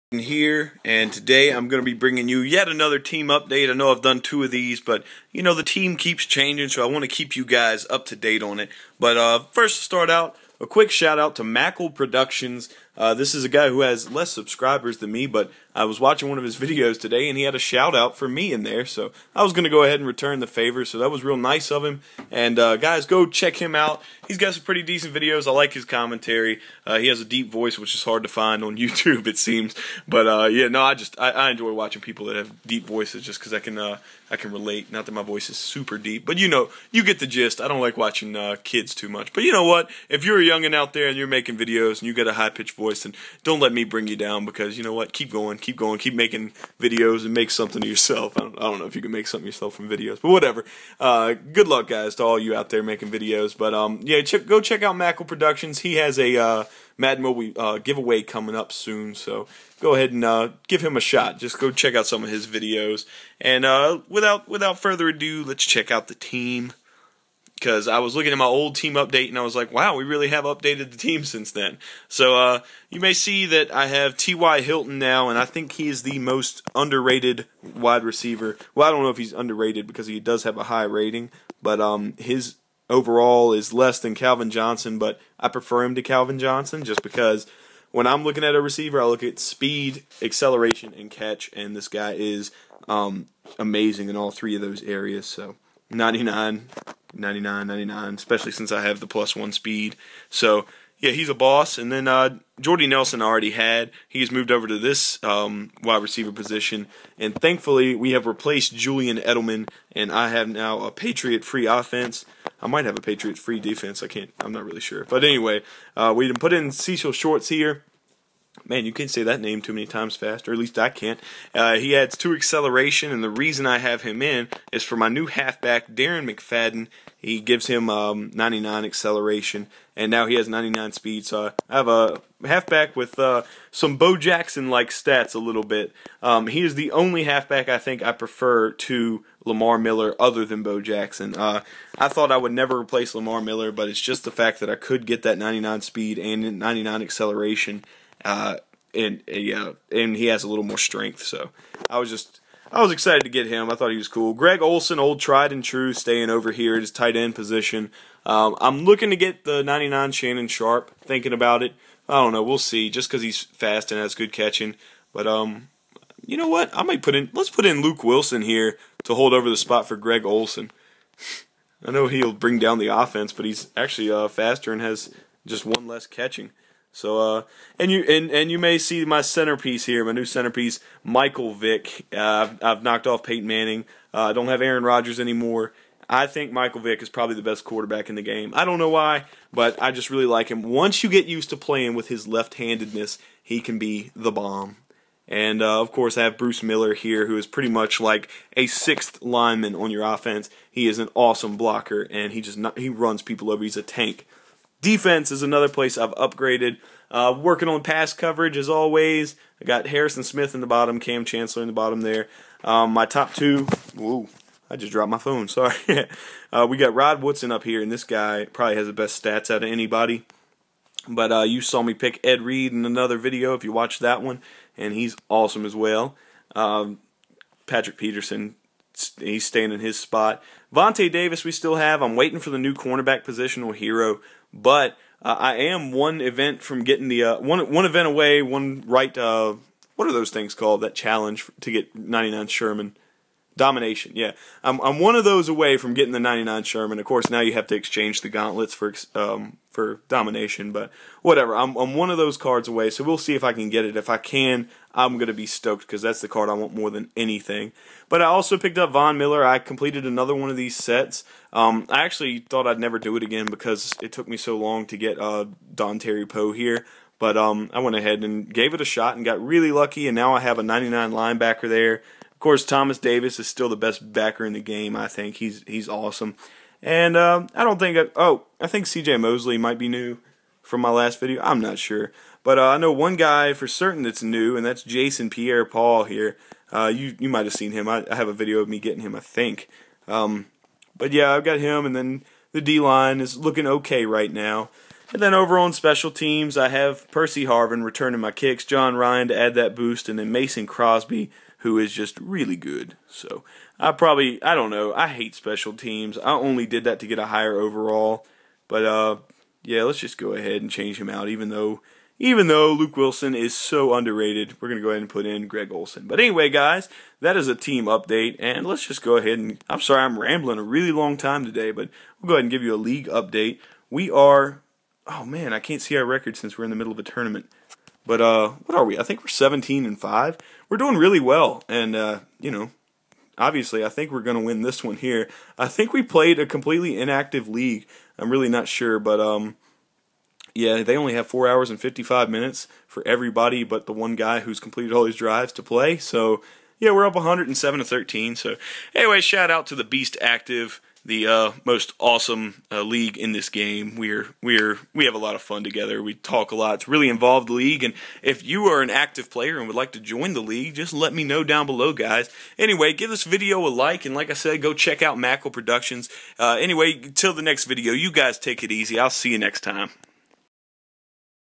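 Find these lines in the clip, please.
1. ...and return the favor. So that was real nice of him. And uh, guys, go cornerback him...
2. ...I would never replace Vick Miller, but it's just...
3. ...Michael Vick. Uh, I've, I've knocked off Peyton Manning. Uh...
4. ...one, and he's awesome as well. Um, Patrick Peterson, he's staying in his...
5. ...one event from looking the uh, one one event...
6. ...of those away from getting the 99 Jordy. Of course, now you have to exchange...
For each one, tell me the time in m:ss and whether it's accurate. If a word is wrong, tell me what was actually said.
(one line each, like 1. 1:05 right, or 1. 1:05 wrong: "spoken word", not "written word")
1. 0:19 wrong: "check", not "cornerback"
2. 2:22 wrong: "Lamar", not "Vick"
3. 3:01 right
4. 3:44 right
5. 3:55 wrong: "getting", not "looking"
6. 4:05 wrong: "Sherman", not "Jordy".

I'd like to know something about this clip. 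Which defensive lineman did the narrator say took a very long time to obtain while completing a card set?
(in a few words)
Dontari Poe.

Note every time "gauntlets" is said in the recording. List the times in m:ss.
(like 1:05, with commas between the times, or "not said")
4:08.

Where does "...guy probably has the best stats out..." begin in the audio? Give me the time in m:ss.
3:38.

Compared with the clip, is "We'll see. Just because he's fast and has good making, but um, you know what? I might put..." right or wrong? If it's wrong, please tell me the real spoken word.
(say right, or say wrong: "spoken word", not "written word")
wrong: "catching", not "making".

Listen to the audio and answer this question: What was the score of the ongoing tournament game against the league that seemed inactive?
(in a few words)
107 to 13.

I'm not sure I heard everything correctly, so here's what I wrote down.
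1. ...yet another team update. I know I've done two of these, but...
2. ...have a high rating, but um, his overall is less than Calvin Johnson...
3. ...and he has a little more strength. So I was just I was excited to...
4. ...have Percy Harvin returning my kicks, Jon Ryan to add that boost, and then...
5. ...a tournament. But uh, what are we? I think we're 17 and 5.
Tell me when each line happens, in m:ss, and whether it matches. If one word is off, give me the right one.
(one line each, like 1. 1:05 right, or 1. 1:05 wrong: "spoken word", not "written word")
1. 0:02 right
2. 1:20 right
3. 2:29 right
4. 4:56 right
5. 5:26 right.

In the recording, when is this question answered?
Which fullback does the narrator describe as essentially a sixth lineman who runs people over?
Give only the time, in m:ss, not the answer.
3:16.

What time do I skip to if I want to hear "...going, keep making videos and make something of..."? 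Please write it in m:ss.
0:45.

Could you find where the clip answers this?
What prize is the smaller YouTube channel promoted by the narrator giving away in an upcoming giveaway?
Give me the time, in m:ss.
0:56.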